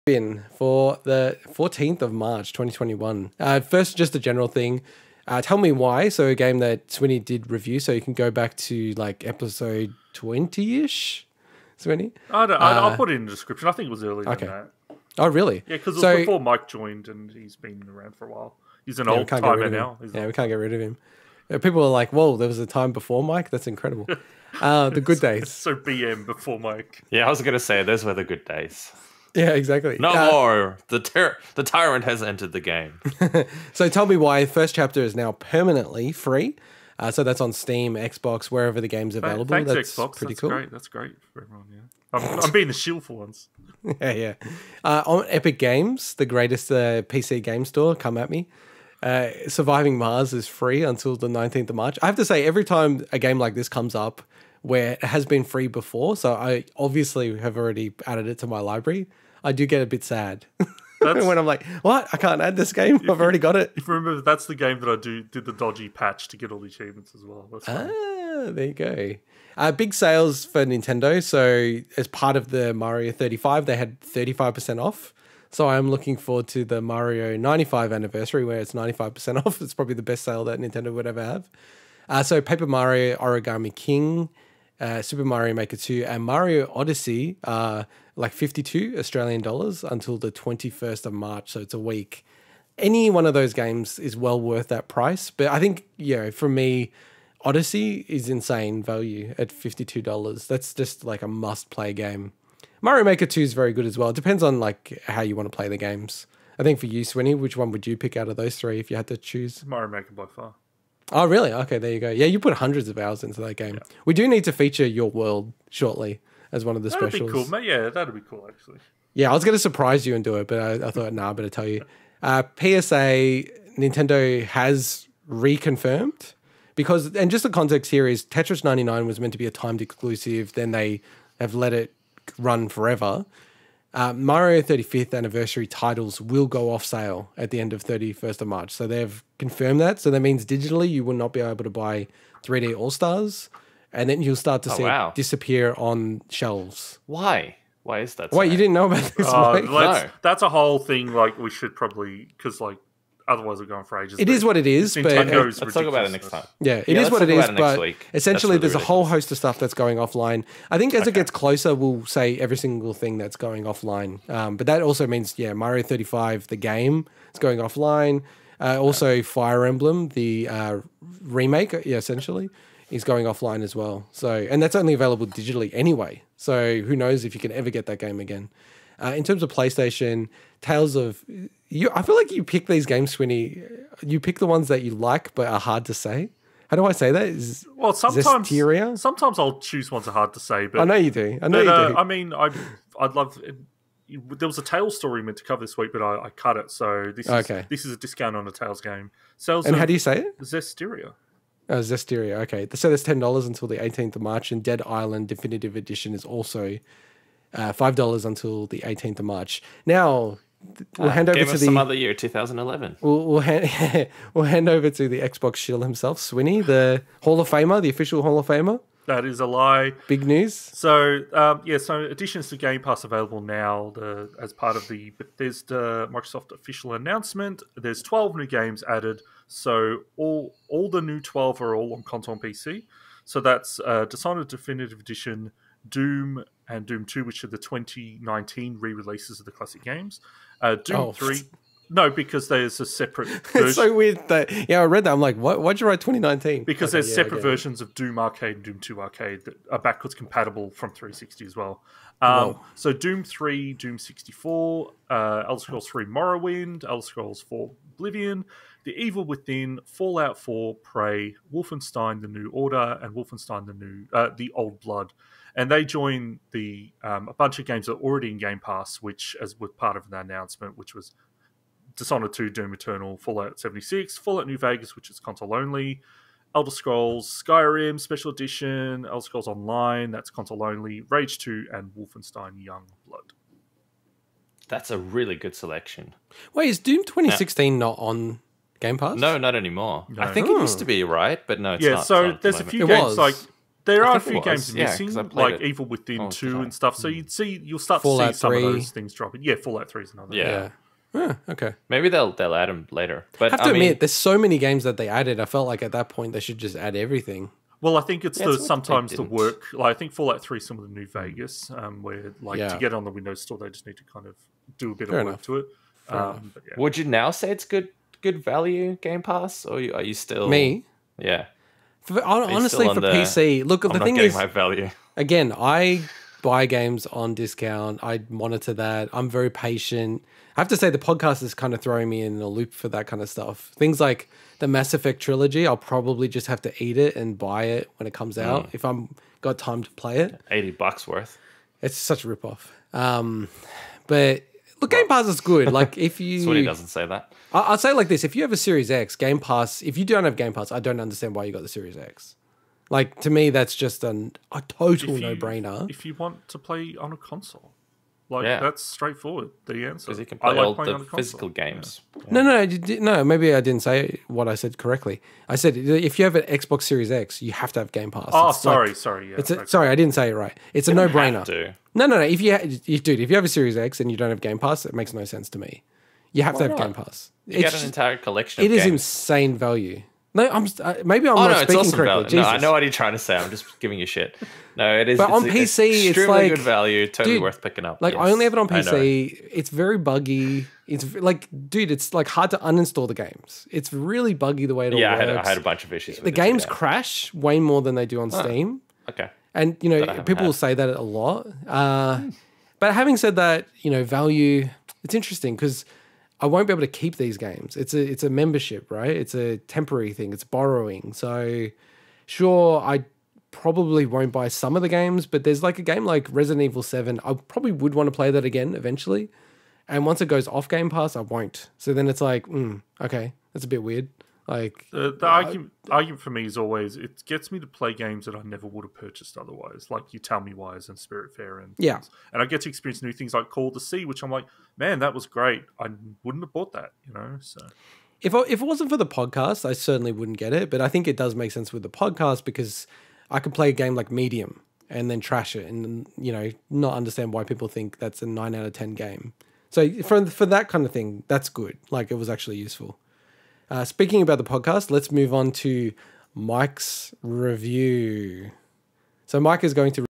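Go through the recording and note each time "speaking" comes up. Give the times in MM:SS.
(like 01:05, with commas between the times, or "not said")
06:21, 07:33.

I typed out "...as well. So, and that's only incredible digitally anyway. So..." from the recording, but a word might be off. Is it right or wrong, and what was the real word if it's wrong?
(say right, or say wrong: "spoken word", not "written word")
wrong: "available", not "incredible".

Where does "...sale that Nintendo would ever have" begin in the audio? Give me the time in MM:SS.
01:20.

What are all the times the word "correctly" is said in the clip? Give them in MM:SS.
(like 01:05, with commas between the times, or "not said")
06:04, 06:21.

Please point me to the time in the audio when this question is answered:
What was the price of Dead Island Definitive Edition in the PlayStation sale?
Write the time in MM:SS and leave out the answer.
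03:27.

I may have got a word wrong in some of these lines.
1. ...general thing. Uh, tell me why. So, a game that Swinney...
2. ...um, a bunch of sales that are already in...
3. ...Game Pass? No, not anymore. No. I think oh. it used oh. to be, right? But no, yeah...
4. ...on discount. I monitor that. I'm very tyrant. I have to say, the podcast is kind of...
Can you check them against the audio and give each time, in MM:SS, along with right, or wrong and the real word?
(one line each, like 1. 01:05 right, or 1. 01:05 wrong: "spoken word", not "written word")
1. 00:04 right
2. 04:27 wrong: "games", not "sales"
3. 04:48 right
4. 05:27 wrong: "patient", not "tyrant".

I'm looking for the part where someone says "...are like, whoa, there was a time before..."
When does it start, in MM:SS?
00:21.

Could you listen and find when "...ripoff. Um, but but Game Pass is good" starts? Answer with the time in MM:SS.
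05:42.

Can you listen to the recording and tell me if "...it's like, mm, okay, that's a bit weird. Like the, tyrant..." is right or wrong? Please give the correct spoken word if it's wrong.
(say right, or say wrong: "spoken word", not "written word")
wrong: "argument", not "tyrant".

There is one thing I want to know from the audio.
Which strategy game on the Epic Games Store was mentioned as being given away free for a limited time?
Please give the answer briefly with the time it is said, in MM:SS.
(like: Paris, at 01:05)
Surviving Mars, at 00:49.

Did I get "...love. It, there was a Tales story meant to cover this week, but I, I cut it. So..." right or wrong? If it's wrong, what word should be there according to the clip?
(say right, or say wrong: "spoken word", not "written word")
right.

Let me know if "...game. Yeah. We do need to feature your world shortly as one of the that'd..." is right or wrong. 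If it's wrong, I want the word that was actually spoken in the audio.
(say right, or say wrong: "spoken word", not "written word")
right.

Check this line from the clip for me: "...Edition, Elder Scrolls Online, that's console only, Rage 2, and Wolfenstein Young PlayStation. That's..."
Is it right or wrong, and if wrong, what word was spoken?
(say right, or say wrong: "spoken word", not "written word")
wrong: "Blood", not "PlayStation".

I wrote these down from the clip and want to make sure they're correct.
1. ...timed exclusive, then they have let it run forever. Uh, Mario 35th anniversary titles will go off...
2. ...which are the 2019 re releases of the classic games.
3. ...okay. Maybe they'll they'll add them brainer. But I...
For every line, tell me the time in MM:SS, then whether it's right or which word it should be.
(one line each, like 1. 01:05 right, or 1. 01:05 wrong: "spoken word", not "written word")
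1. 02:09 right
2. 03:57 right
3. 05:01 wrong: "later", not "brainer".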